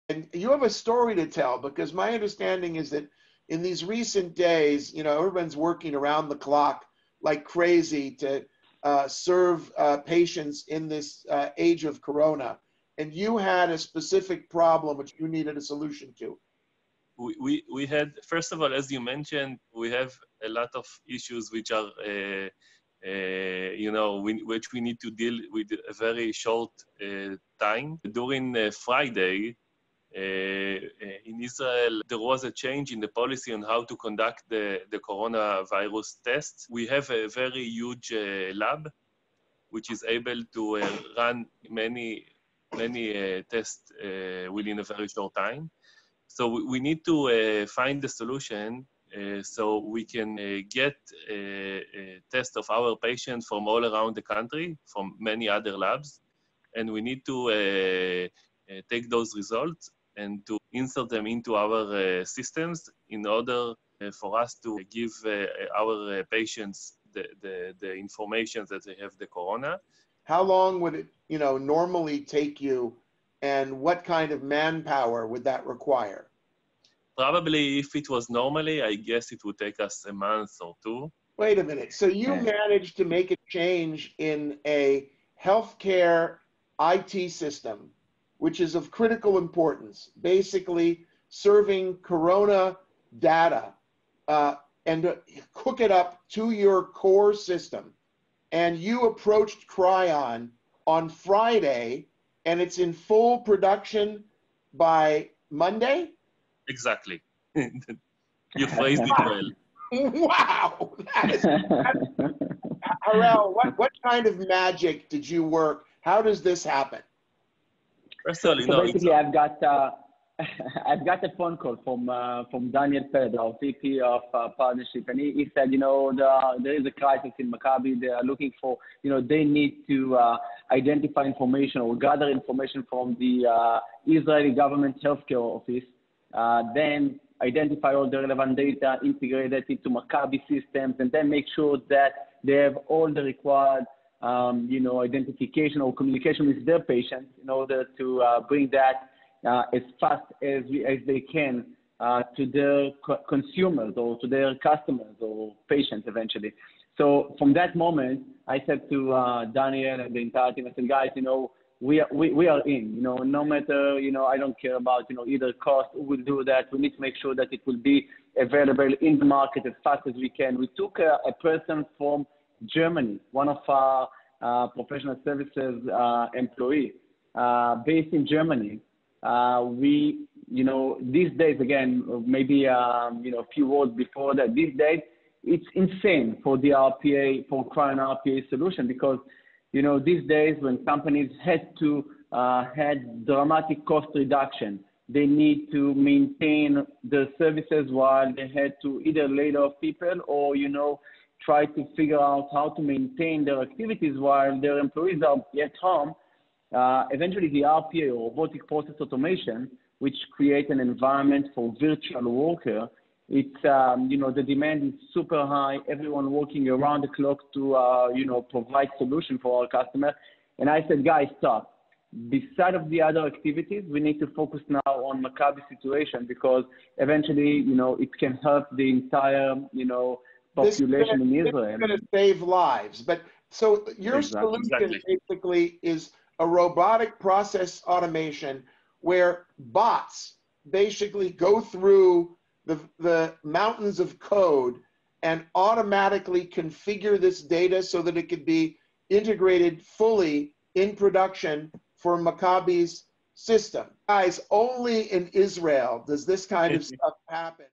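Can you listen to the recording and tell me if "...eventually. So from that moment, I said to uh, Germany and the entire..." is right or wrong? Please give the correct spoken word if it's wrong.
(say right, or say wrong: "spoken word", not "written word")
wrong: "Daniel", not "Germany".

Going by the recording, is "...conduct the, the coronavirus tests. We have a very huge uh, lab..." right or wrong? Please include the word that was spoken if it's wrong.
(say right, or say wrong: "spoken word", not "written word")
right.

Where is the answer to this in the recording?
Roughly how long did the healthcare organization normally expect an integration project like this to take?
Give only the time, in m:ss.
1:20.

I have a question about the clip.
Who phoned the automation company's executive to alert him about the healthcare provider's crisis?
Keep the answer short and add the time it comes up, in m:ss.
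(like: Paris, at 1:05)
Daniel Pedro, at 2:02.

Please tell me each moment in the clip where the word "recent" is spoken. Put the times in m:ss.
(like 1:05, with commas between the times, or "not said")
0:03.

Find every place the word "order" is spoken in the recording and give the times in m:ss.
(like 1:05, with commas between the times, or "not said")
1:03, 2:27.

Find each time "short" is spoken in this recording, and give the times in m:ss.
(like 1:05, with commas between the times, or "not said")
0:26, 0:45.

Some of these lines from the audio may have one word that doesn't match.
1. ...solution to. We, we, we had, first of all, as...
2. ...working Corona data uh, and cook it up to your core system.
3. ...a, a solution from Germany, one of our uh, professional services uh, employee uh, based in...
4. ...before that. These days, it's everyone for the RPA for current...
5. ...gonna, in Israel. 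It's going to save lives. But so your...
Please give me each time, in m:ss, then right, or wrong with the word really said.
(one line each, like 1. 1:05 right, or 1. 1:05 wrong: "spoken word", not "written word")
1. 0:15 right
2. 1:31 wrong: "serving", not "working"
3. 2:50 wrong: "person", not "solution"
4. 3:03 wrong: "insane", not "everyone"
5. 3:51 right.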